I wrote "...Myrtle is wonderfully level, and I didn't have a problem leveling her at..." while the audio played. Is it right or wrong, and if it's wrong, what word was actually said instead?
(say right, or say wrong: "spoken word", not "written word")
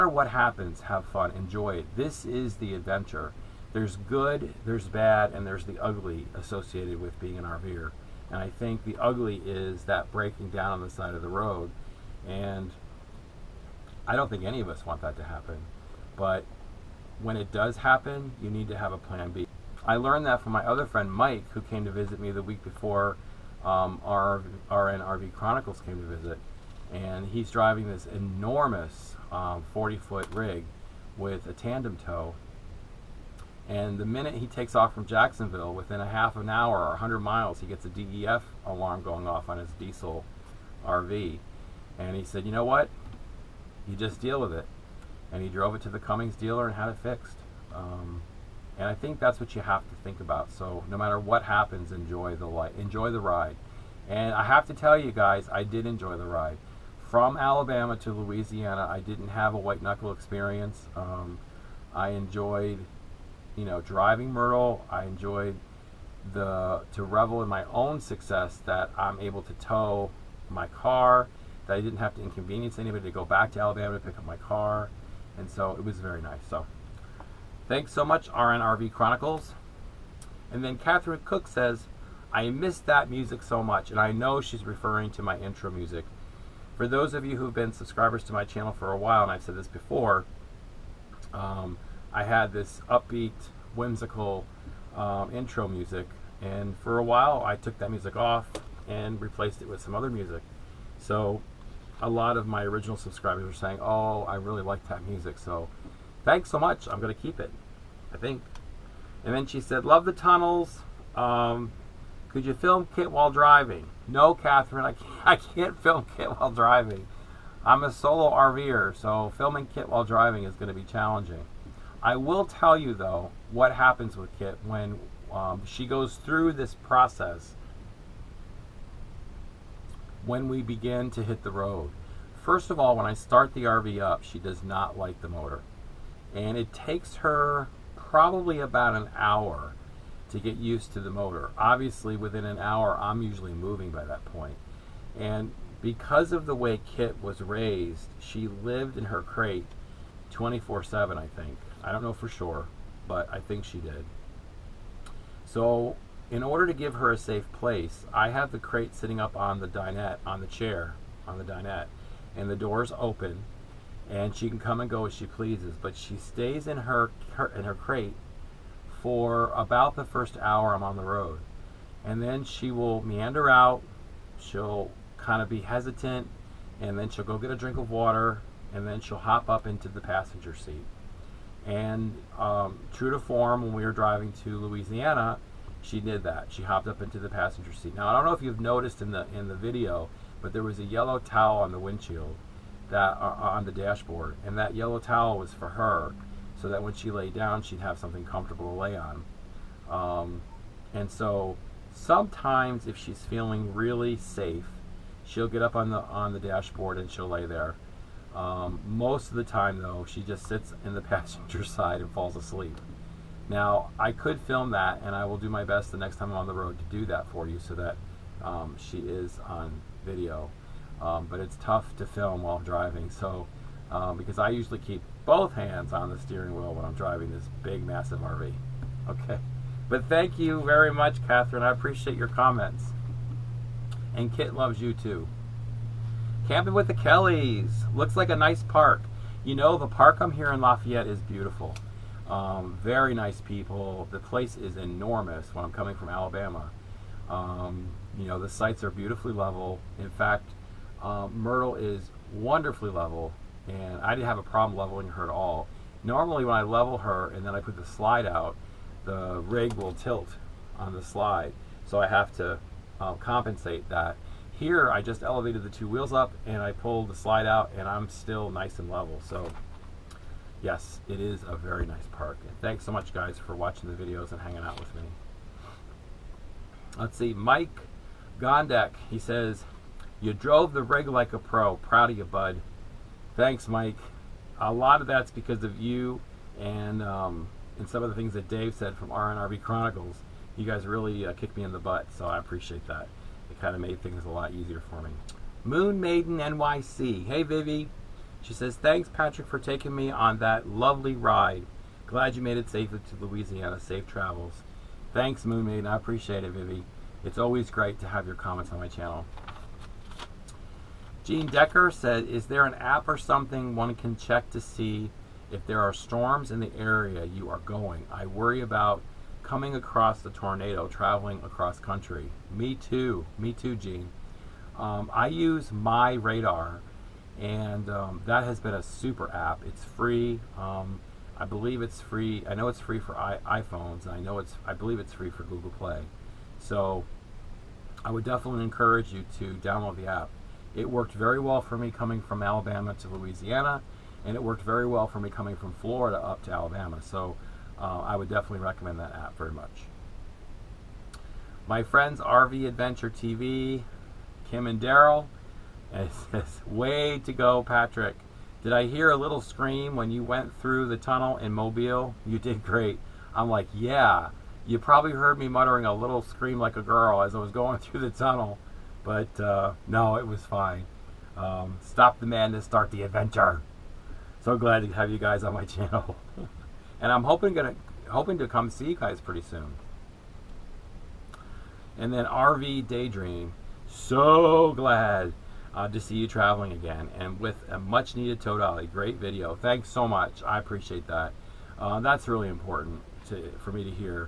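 right.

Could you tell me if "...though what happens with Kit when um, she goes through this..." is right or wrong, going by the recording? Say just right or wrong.
right.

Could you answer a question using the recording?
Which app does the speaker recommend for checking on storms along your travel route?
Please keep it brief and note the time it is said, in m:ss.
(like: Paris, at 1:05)
MyRadar, at 5:25.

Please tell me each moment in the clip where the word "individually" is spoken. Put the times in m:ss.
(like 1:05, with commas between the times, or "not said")
not said.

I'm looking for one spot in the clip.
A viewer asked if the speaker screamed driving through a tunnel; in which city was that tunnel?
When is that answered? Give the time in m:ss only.
6:01.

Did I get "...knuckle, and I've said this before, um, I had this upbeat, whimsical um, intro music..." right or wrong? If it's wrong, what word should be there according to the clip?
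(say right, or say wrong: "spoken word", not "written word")
wrong: "while", not "knuckle".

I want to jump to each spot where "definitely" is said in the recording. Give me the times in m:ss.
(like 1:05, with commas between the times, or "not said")
5:38, 5:48.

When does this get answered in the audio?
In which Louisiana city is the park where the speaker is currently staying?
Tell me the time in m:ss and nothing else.
4:00.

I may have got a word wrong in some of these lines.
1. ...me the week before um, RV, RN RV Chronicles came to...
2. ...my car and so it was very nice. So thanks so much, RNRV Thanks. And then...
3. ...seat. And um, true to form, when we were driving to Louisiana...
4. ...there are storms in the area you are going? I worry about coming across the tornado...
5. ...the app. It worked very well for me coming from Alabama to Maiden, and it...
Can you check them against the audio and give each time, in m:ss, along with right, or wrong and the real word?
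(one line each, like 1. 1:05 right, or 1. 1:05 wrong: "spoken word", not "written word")
1. 0:22 right
2. 1:14 wrong: "Chronicles", not "Thanks"
3. 3:00 right
4. 5:15 right
5. 5:39 wrong: "Louisiana", not "Maiden".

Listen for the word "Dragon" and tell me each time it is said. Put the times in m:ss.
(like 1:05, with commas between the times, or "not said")
not said.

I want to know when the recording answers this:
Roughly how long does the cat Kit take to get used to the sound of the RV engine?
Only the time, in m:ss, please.
2:18.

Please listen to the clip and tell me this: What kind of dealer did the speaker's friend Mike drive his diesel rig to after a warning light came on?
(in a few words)
Cummins.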